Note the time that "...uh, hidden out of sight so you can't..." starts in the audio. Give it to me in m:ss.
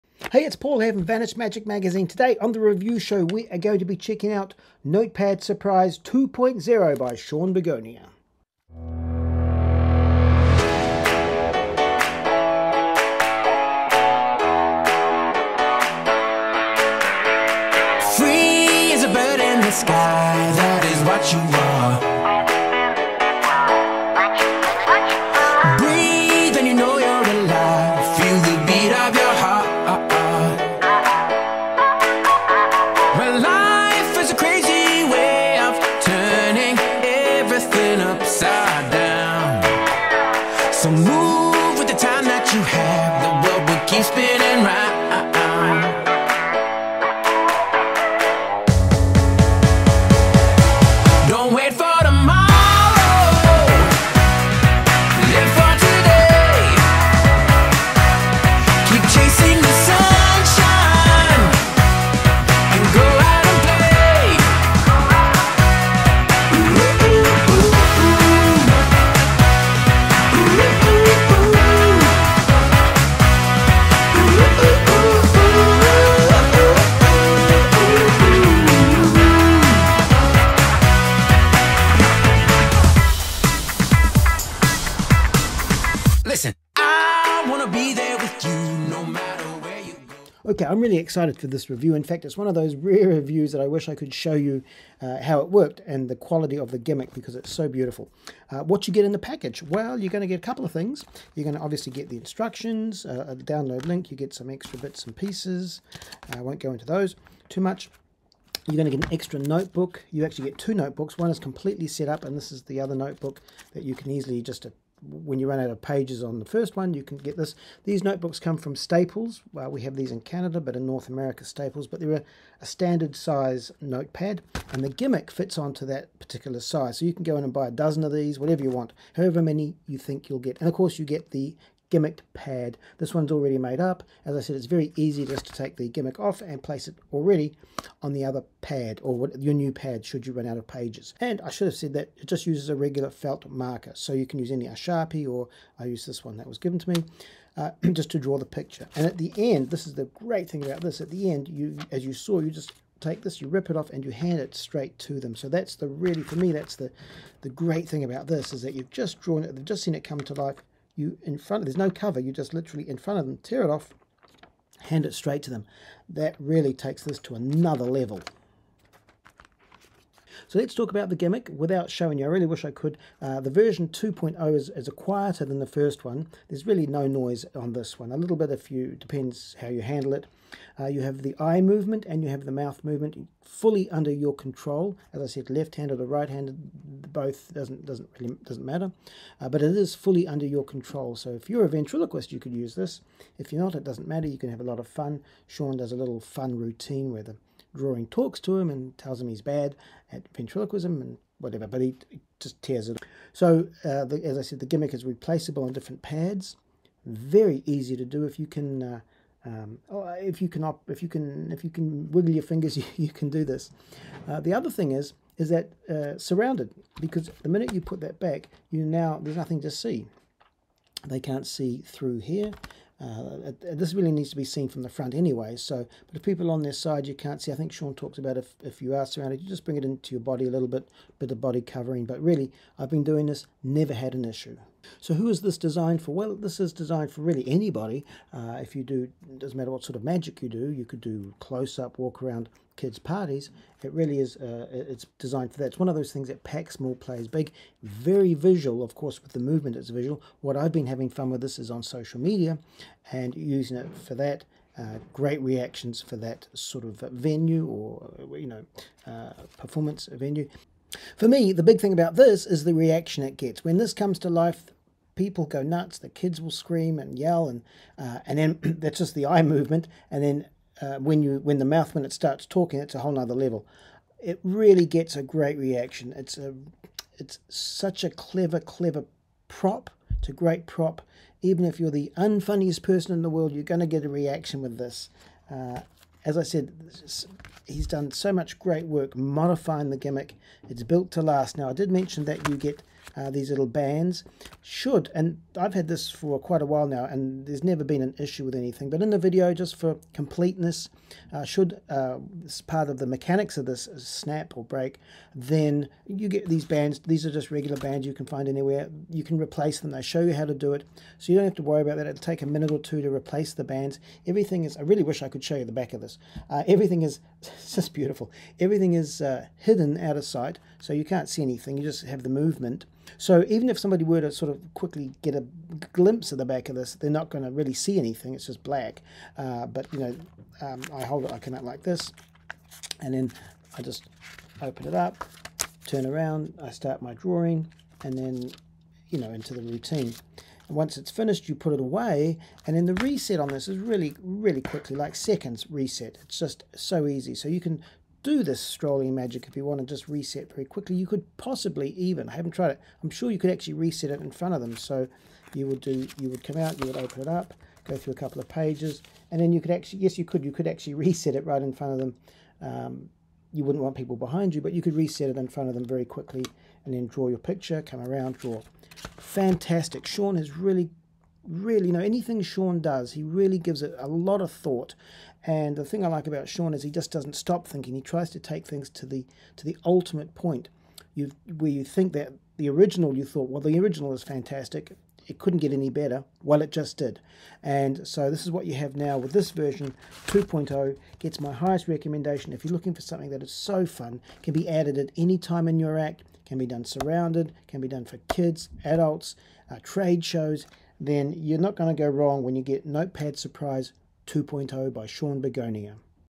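5:19.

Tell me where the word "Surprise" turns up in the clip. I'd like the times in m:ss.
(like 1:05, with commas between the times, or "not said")
0:05, 6:43.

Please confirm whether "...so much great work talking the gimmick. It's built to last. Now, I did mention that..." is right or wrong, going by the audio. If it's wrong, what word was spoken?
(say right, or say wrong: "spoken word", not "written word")
wrong: "modifying", not "talking".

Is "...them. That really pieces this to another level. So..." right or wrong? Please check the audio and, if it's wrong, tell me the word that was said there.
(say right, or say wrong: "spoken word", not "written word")
wrong: "takes", not "pieces".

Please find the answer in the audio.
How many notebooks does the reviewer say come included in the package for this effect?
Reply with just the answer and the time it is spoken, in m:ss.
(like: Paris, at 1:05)
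2, at 1:50.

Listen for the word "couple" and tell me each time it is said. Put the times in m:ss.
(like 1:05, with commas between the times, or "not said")
1:40, 5:58.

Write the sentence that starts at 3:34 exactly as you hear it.
Uh, the other thing is, is that uh, surrounded because the minute you put that back, you now there's nothing to see.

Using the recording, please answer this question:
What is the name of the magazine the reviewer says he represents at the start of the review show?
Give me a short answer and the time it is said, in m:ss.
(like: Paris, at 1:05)
Vanish Magic Magazine, at 0:01.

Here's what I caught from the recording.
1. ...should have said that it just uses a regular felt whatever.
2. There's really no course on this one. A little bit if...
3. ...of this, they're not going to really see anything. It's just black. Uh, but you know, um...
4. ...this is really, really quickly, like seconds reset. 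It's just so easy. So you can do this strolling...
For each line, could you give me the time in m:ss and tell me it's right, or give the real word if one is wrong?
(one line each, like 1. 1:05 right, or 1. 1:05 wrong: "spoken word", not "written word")
1. 2:21 wrong: "marker", not "whatever"
2. 2:56 wrong: "noise", not "course"
3. 5:26 right
4. 5:43 right.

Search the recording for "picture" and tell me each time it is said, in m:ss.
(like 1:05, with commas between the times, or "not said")
2:28, 6:07.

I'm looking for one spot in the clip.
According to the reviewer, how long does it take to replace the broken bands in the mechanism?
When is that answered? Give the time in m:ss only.
5:12.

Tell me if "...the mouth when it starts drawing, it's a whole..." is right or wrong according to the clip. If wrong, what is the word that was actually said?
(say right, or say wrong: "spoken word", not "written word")
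wrong: "talking", not "drawing".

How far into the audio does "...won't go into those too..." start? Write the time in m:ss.
1:46.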